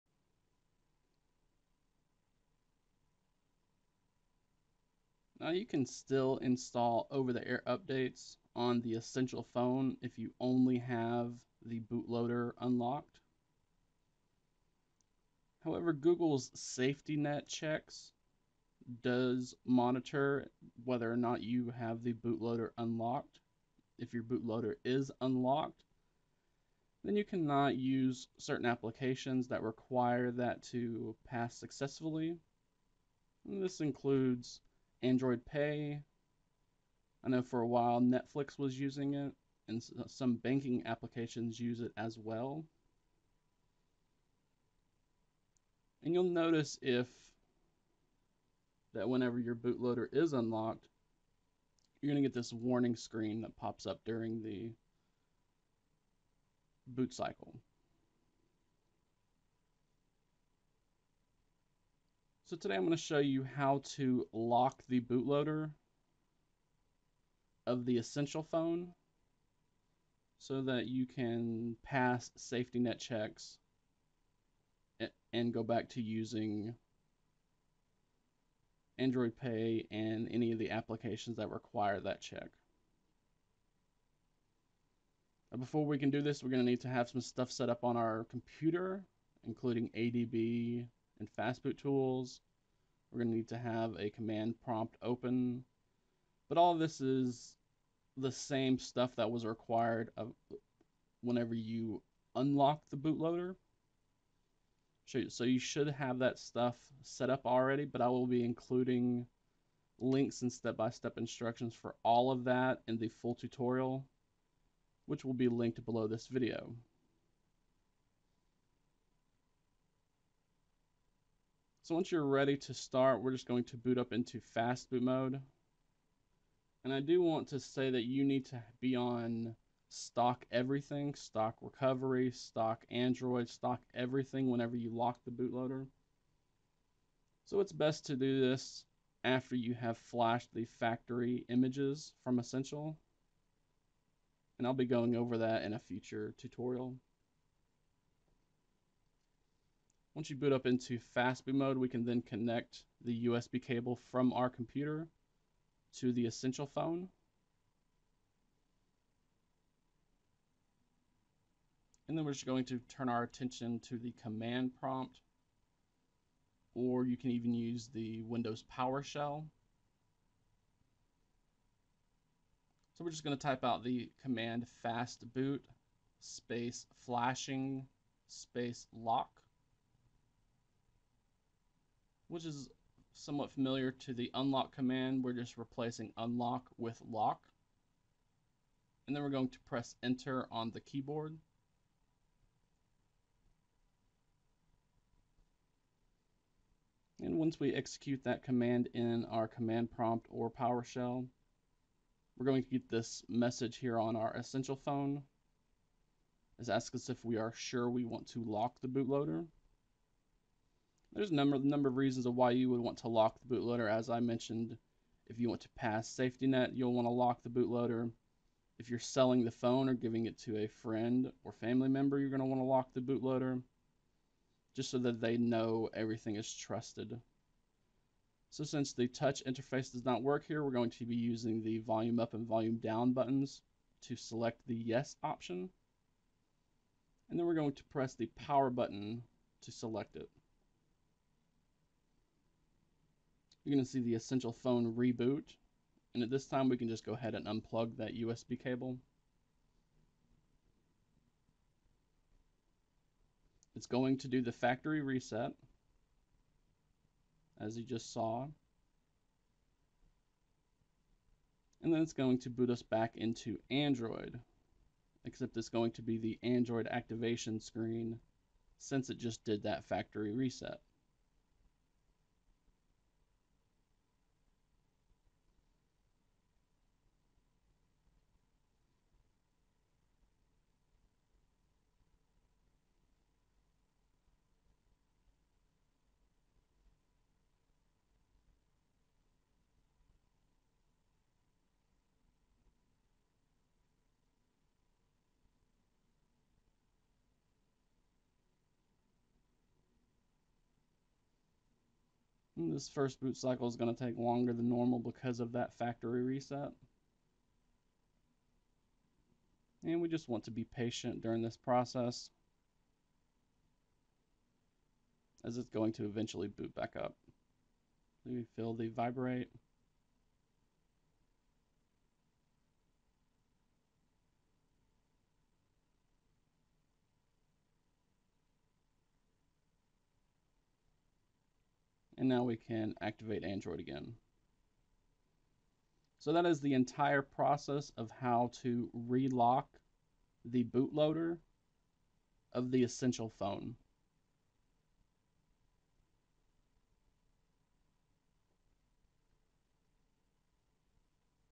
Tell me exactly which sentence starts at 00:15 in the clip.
However, Google's safety net checks does monitor whether or not you have the bootloader unlocked.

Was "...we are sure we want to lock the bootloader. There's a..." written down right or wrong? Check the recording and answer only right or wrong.
right.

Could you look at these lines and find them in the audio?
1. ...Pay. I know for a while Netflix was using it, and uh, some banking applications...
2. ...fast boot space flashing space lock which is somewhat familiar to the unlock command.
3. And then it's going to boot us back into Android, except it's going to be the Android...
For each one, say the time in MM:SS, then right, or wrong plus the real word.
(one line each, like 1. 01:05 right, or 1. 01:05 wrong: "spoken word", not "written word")
1. 00:35 right
2. 02:54 right
3. 04:21 right.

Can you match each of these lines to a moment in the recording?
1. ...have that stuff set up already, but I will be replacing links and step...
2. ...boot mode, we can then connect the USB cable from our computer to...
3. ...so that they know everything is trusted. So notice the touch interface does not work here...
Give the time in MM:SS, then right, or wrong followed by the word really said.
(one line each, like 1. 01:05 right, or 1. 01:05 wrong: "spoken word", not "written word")
1. 01:45 wrong: "including", not "replacing"
2. 02:31 right
3. 03:44 wrong: "since", not "notice".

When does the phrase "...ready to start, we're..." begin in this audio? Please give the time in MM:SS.
02:02.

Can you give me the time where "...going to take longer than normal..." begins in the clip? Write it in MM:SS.
05:03.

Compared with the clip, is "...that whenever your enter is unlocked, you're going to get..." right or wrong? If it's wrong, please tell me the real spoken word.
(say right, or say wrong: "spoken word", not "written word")
wrong: "bootloader", not "enter".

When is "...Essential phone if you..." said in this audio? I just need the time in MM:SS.
00:08.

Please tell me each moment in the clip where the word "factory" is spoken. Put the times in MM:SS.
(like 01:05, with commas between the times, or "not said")
02:20, 04:14, 04:29, 05:05.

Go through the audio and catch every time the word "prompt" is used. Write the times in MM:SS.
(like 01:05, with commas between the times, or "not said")
01:34, 02:44, 03:19.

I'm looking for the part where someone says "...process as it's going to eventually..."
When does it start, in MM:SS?
05:11.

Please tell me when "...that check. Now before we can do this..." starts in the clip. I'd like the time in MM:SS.
01:22.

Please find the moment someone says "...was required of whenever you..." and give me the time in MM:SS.
01:39.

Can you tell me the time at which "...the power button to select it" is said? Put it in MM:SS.
03:58.